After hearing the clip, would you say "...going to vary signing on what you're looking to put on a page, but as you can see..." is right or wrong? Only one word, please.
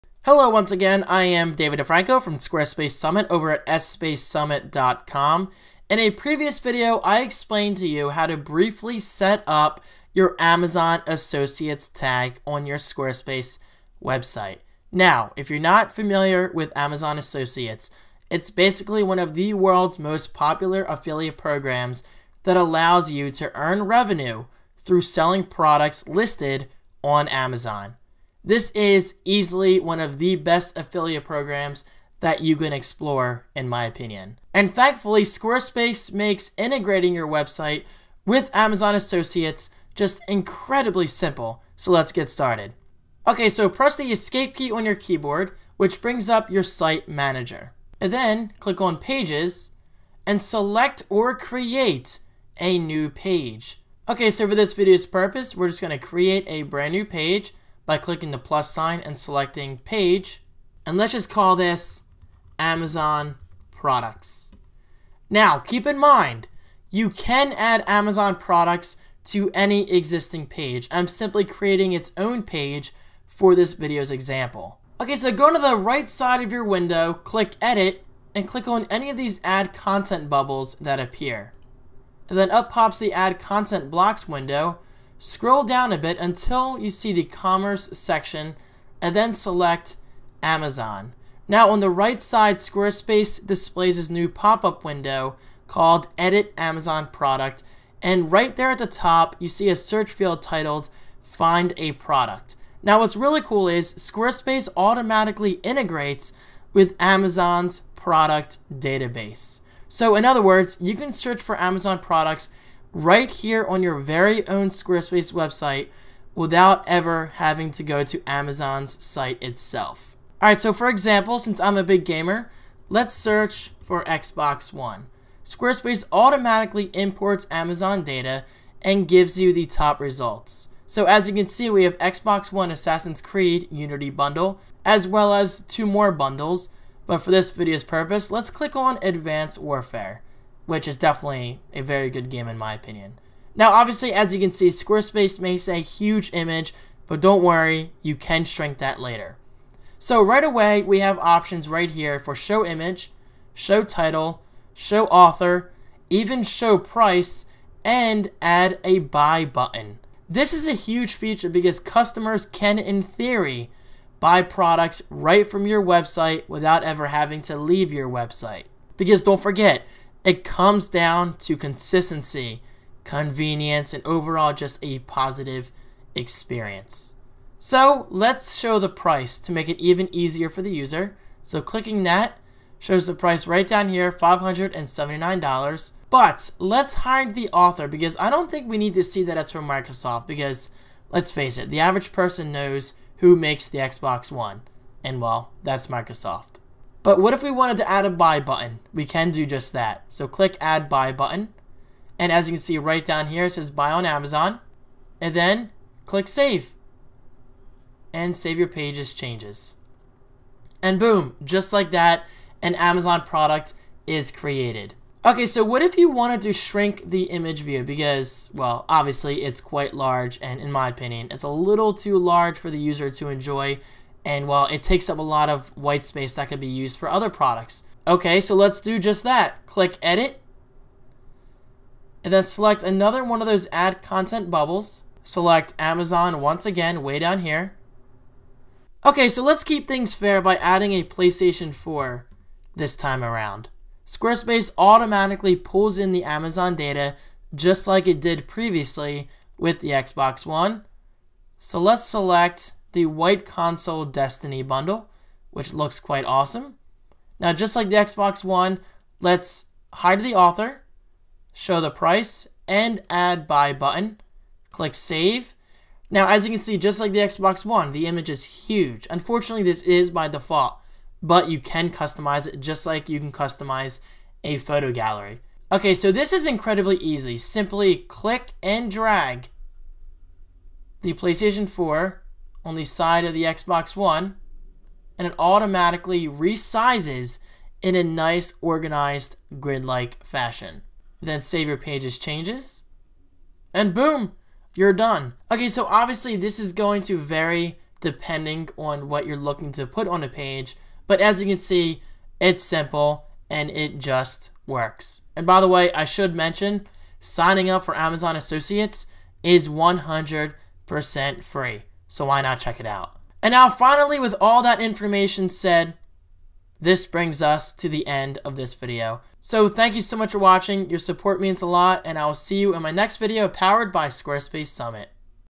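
wrong.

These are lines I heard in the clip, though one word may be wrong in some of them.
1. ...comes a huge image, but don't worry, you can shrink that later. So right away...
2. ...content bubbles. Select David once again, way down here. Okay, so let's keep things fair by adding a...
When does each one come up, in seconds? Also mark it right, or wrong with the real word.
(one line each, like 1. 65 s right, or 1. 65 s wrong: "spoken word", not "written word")
1. 145 s wrong: "makes", not "comes"
2. 234 s wrong: "Amazon", not "David".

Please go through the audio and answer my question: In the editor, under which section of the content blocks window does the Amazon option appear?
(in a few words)
commerce.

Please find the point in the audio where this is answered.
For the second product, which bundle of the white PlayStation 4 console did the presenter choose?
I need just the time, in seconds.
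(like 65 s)
254 s.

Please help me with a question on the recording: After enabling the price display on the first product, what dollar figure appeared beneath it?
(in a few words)
$579.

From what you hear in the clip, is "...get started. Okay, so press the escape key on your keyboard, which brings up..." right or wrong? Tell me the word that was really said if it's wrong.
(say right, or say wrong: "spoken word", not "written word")
right.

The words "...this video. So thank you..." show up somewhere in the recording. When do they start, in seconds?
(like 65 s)
318 s.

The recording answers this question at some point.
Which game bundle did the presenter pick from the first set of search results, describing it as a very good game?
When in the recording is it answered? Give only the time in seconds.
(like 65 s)
139 s.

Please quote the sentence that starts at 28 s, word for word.
This is easily one of the best affiliate programs that you can explore, in my opinion.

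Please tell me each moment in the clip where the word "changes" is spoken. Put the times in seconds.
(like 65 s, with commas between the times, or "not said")
209 s, 292 s.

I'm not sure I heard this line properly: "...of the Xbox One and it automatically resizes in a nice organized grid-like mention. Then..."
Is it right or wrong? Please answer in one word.
wrong.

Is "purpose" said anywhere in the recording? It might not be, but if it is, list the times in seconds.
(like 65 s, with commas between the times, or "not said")
55 s, 137 s.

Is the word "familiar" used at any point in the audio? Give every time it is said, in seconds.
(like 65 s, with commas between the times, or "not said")
15 s.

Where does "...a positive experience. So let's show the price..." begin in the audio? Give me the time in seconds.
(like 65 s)
174 s.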